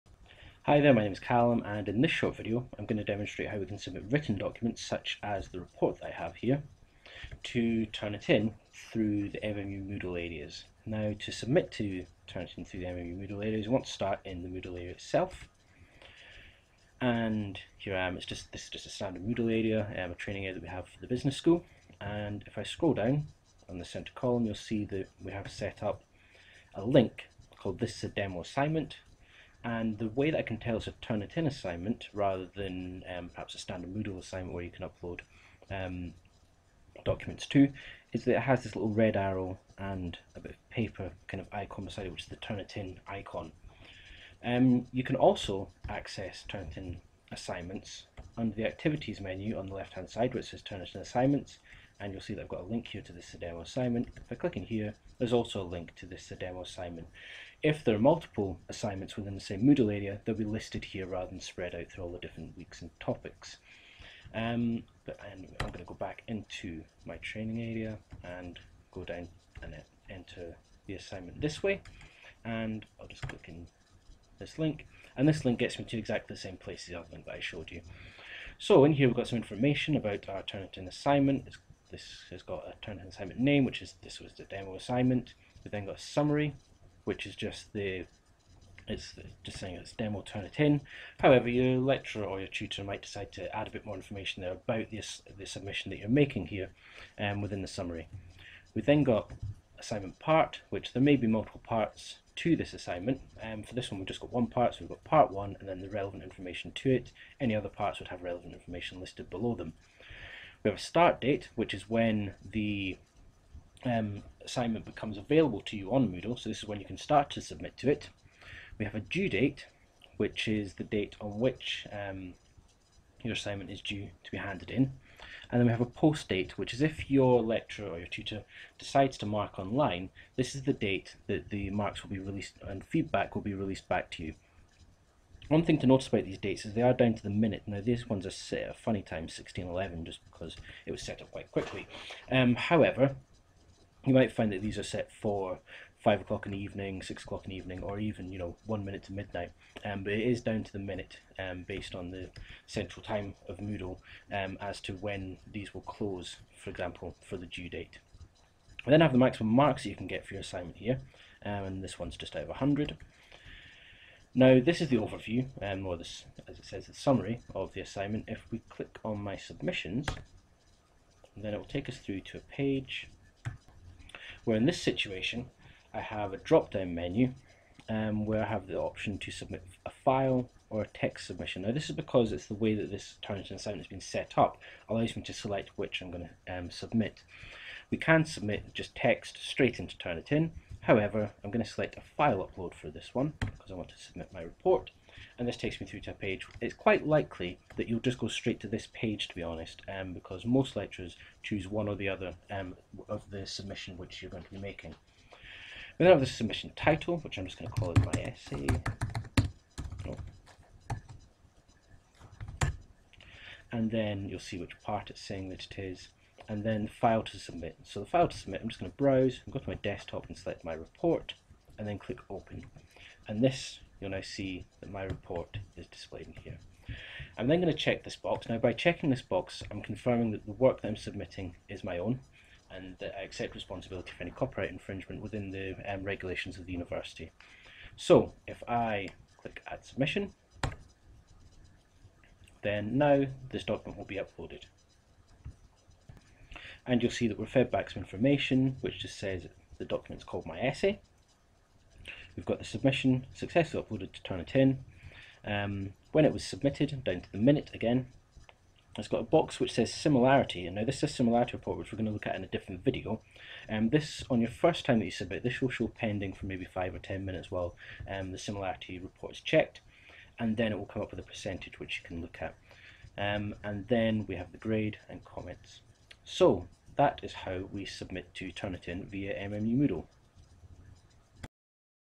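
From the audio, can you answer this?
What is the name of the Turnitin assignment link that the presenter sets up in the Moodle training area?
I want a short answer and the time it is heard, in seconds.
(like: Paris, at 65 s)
This is a demo assignment, at 27 s.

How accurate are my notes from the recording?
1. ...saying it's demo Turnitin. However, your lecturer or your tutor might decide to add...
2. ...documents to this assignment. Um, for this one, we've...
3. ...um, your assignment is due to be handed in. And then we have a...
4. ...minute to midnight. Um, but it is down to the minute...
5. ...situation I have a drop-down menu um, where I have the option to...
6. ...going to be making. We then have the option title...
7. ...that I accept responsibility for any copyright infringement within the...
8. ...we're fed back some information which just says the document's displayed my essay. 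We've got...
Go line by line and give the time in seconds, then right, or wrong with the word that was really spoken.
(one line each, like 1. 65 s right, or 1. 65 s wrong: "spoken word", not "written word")
1. 89 s right
2. 101 s wrong: "parts", not "documents"
3. 121 s right
4. 148 s right
5. 174 s right
6. 204 s wrong: "submission", not "option"
7. 232 s right
8. 247 s wrong: "called", not "displayed".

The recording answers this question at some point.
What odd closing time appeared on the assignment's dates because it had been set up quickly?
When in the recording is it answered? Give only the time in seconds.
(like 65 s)
139 s.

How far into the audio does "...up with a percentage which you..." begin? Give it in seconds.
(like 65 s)
271 s.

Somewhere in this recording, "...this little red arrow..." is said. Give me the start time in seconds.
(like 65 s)
38 s.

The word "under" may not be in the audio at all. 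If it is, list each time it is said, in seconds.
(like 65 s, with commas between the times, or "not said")
48 s.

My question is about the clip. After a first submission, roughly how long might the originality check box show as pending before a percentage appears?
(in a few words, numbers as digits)
5 or 10 minutes.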